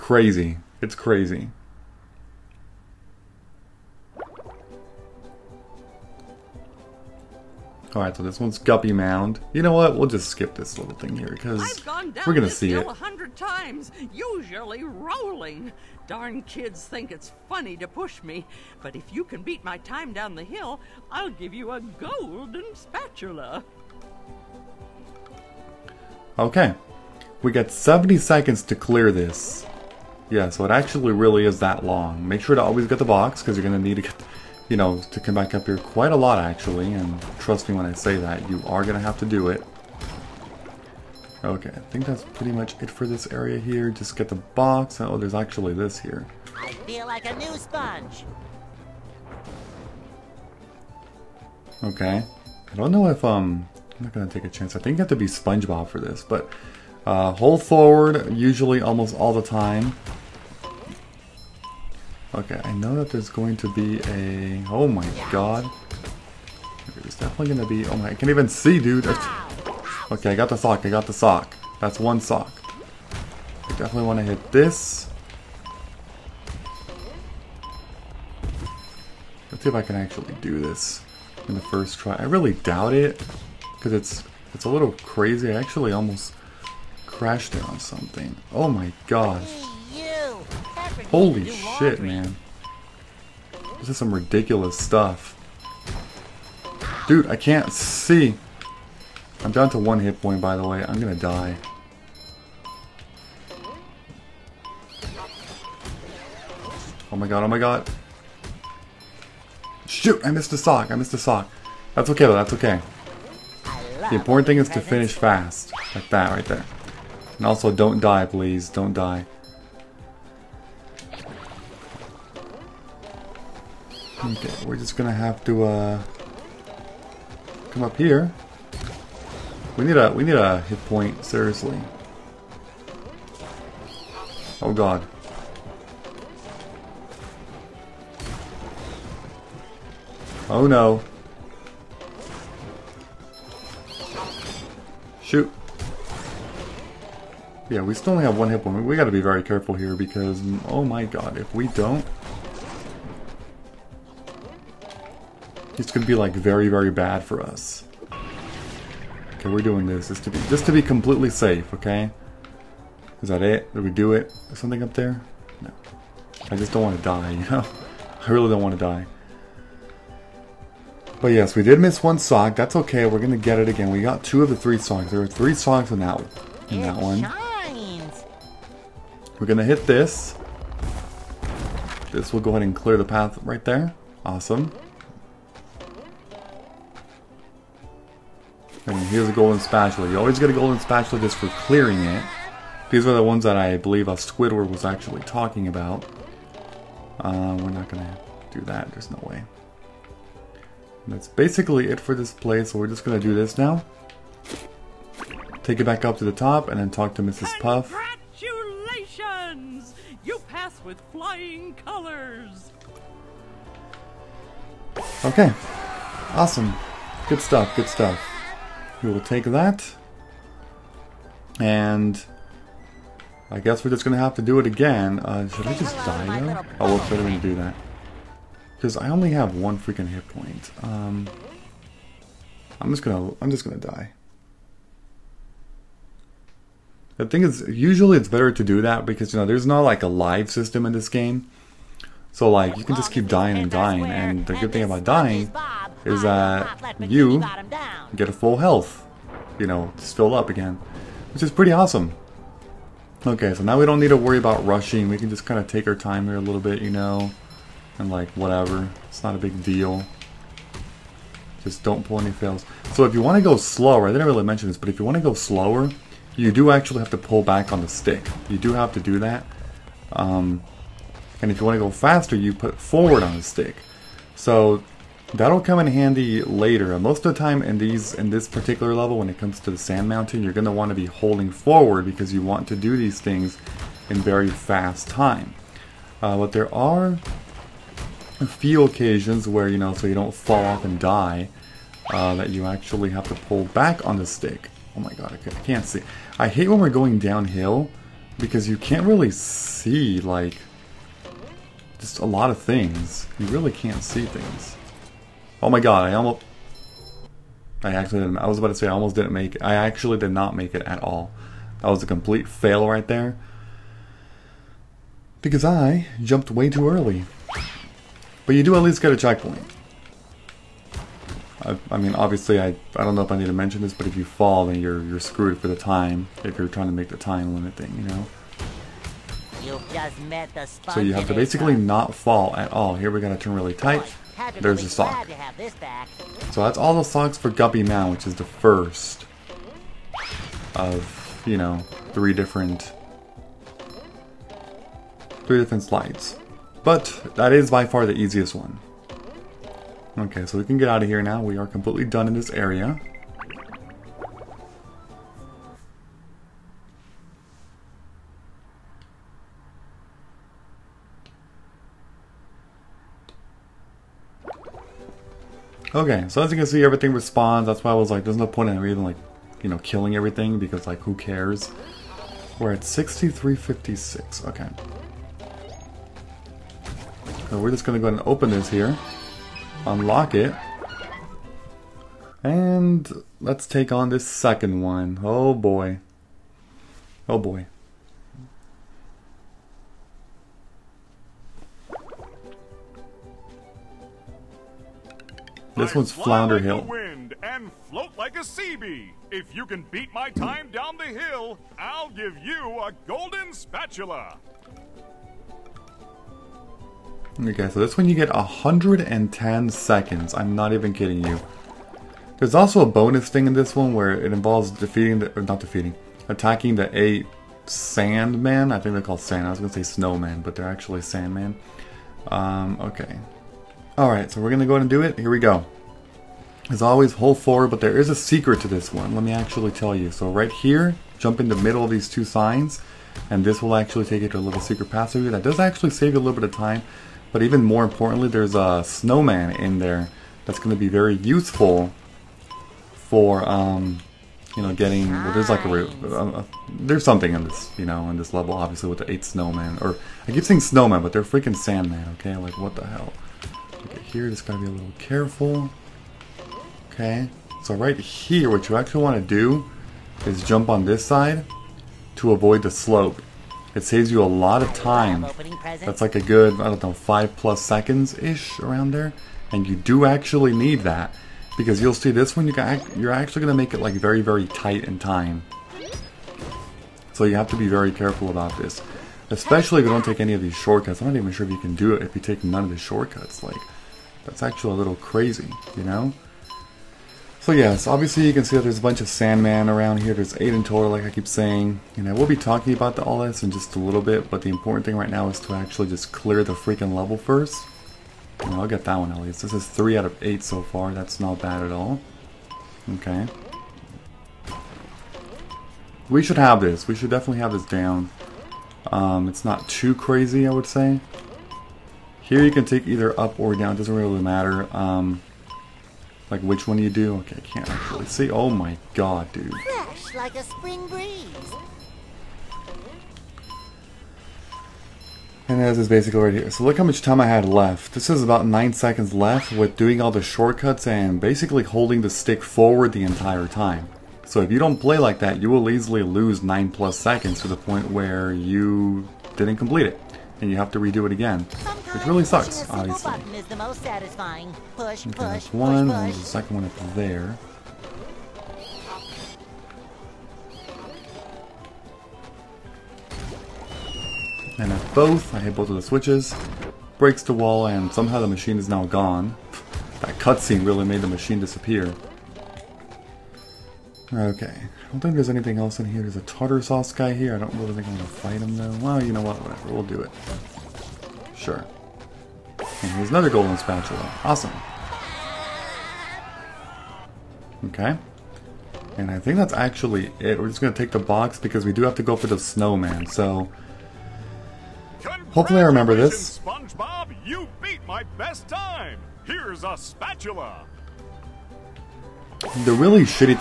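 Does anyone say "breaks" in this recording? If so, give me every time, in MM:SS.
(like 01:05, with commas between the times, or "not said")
09:16.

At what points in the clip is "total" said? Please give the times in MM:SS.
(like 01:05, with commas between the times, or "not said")
08:10.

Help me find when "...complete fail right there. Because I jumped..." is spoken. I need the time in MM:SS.
05:12.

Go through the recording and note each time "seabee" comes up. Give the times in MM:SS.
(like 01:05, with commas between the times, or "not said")
06:38.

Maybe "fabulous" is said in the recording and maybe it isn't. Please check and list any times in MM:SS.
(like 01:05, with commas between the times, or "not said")
not said.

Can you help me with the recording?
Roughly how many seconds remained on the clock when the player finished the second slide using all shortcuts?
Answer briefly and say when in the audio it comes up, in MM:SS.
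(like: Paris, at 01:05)
9, at 08:48.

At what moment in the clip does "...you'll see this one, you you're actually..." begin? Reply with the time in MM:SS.
07:51.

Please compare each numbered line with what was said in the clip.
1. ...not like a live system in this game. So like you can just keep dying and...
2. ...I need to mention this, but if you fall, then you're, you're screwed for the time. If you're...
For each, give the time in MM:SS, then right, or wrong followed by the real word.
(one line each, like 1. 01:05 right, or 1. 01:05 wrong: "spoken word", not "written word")
1. 03:59 right
2. 05:23 right.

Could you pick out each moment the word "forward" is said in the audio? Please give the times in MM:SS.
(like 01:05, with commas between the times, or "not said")
00:57, 04:32, 04:41, 07:07, 08:52.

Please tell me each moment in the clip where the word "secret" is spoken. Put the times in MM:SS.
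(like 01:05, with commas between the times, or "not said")
07:08, 07:14.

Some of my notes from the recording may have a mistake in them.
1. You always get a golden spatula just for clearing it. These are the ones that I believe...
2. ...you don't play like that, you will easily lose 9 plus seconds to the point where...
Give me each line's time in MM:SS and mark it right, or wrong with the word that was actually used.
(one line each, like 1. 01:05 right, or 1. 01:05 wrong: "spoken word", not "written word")
1. 03:10 right
2. 08:54 right.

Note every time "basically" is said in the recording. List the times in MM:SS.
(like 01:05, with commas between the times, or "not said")
03:21, 05:31, 08:45, 08:51.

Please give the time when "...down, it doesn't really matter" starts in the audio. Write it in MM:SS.
08:33.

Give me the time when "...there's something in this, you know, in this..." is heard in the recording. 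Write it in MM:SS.
07:26.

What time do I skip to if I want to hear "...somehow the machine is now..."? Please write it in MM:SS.
09:17.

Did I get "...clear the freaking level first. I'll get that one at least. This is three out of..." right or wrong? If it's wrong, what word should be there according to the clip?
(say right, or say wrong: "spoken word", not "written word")
right.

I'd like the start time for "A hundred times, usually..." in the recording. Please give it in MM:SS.
00:12.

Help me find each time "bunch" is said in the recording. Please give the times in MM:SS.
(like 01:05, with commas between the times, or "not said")
08:08.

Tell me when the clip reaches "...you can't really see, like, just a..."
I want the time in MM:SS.
04:58.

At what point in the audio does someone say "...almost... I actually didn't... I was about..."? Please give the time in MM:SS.
05:06.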